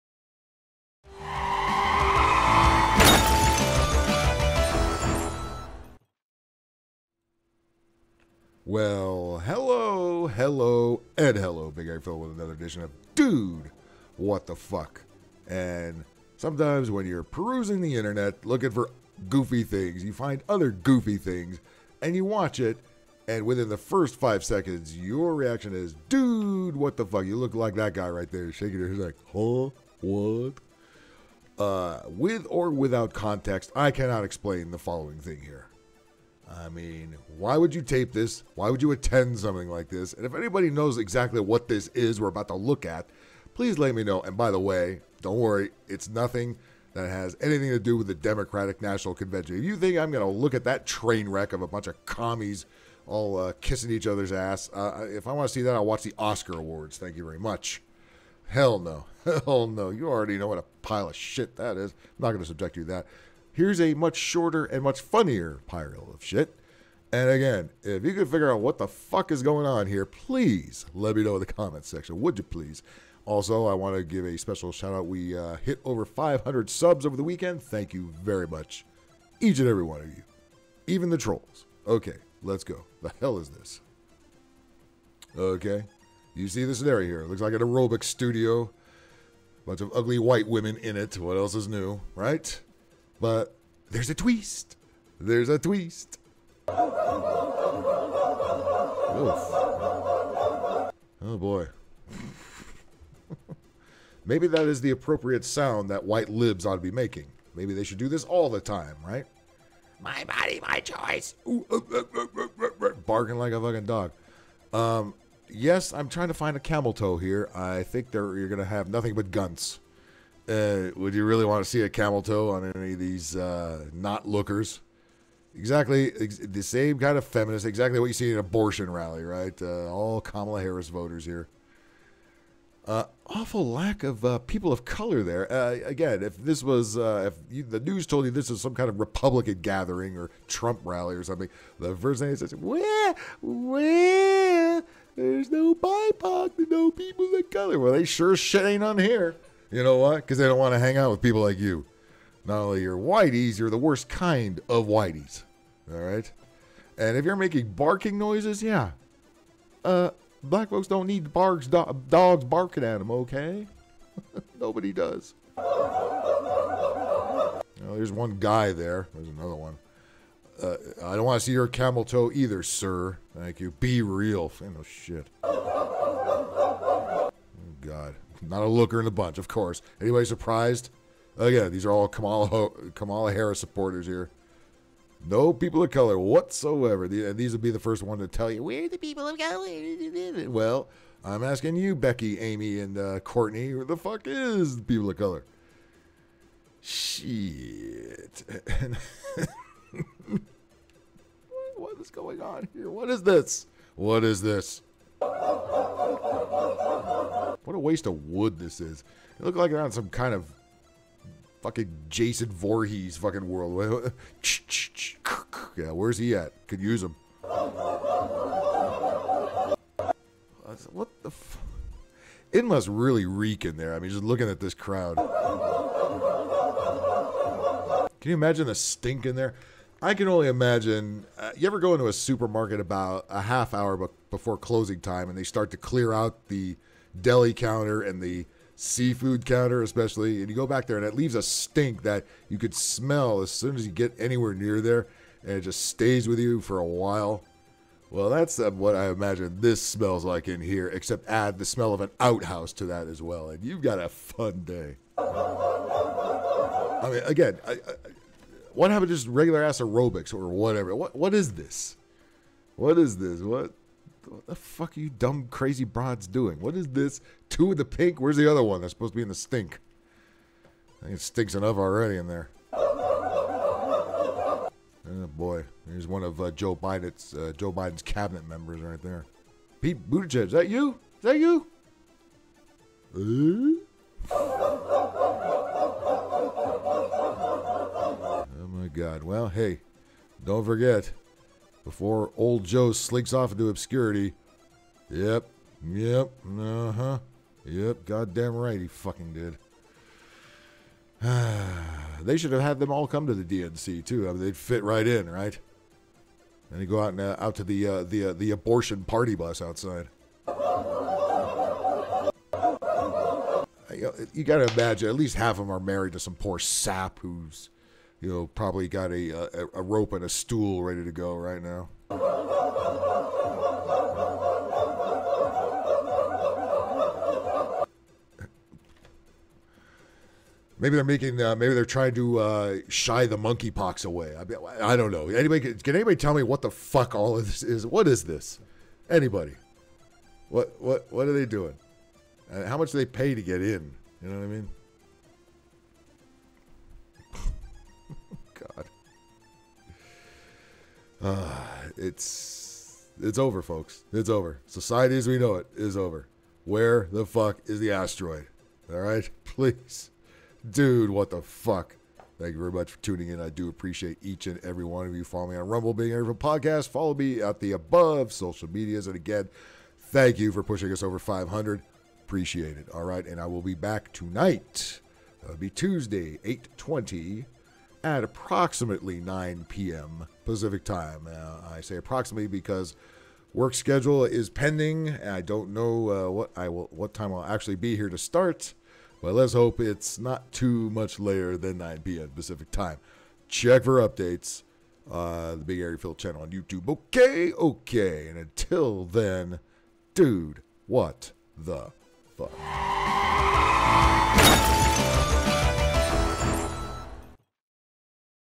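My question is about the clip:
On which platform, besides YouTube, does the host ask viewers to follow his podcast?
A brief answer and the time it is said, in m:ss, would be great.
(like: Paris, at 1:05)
Rumble, at 6:05.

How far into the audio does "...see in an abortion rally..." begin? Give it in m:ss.
2:08.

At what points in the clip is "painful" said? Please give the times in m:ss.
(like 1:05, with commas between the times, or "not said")
not said.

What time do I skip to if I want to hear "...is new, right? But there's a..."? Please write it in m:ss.
1:31.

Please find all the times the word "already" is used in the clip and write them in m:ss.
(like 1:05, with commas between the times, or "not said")
1:00, 4:31.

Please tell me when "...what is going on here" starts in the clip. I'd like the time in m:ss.
3:21.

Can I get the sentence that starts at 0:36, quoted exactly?
I mean, why would you tape this?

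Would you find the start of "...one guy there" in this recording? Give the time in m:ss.
2:48.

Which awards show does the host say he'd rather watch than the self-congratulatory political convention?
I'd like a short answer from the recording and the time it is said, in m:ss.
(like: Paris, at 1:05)
Oscar Awards, at 0:56.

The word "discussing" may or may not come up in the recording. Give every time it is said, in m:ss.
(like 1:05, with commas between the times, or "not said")
not said.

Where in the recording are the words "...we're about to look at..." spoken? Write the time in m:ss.
0:42.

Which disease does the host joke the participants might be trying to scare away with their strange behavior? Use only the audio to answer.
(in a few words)
monkeypox.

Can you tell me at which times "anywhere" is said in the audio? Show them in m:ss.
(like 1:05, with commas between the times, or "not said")
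4:04.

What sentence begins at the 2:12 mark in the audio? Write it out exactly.
Uh, awful lack of uh, people of color there.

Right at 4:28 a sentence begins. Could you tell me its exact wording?
Where's the other one that's supposed to be in the stink?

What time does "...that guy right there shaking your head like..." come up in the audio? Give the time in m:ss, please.
0:27.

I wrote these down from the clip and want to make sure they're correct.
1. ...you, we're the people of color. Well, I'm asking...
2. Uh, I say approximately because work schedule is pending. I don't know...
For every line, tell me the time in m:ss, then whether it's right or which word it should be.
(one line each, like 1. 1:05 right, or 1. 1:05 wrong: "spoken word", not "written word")
1. 3:08 right
2. 6:21 right.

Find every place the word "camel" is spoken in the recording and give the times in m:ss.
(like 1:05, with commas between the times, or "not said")
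1:56, 2:01, 2:51.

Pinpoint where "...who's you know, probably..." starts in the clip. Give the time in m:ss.
5:17.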